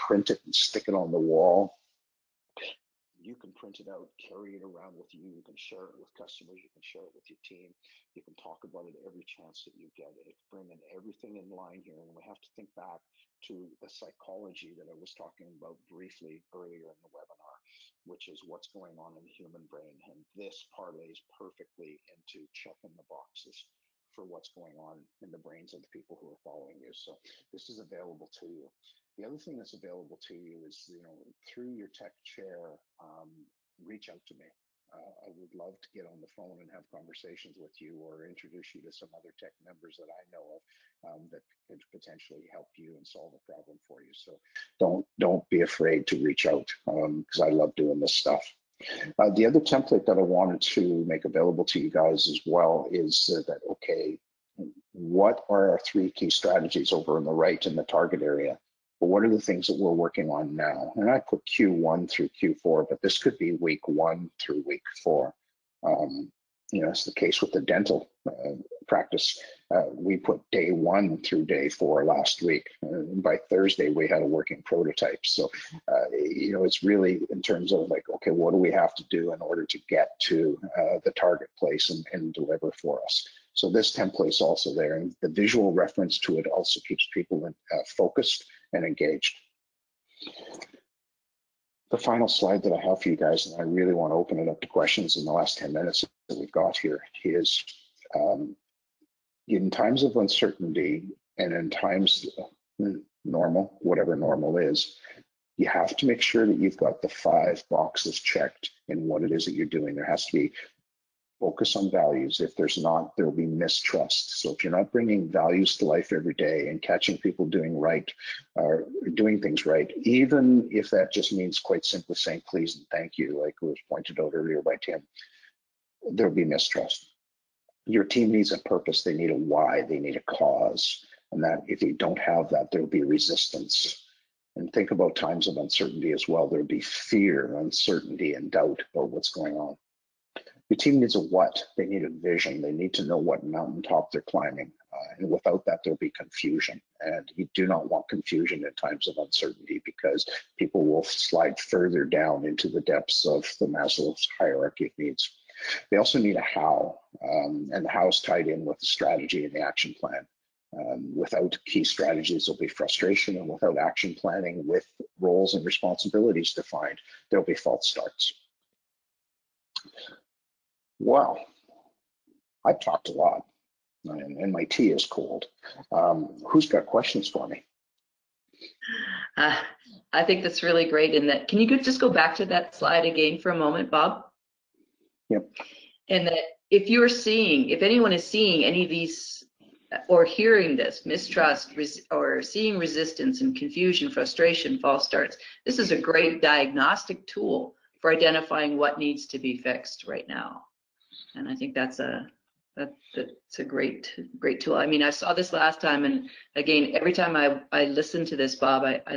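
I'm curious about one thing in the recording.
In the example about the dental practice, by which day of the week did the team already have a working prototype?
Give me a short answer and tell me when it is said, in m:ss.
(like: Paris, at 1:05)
Thursday, at 1:13.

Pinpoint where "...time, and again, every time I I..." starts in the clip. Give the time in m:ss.
3:25.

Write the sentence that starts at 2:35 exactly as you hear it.
They also need a how, um, and the how is tied in with the strategy and the action plan.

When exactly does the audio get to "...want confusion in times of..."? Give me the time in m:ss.
2:27.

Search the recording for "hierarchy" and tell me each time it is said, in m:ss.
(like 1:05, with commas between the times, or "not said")
2:34.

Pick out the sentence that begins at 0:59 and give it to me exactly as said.
But what are the things that we're working on now?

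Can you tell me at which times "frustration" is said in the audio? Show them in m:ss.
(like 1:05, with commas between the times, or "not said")
2:42, 3:14.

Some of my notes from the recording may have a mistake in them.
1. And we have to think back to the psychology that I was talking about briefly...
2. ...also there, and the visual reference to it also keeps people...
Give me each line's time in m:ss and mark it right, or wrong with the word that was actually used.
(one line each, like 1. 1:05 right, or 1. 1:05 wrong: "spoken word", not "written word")
1. 0:11 right
2. 1:24 right.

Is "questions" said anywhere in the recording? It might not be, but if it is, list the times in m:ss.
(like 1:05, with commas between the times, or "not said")
1:34, 2:56.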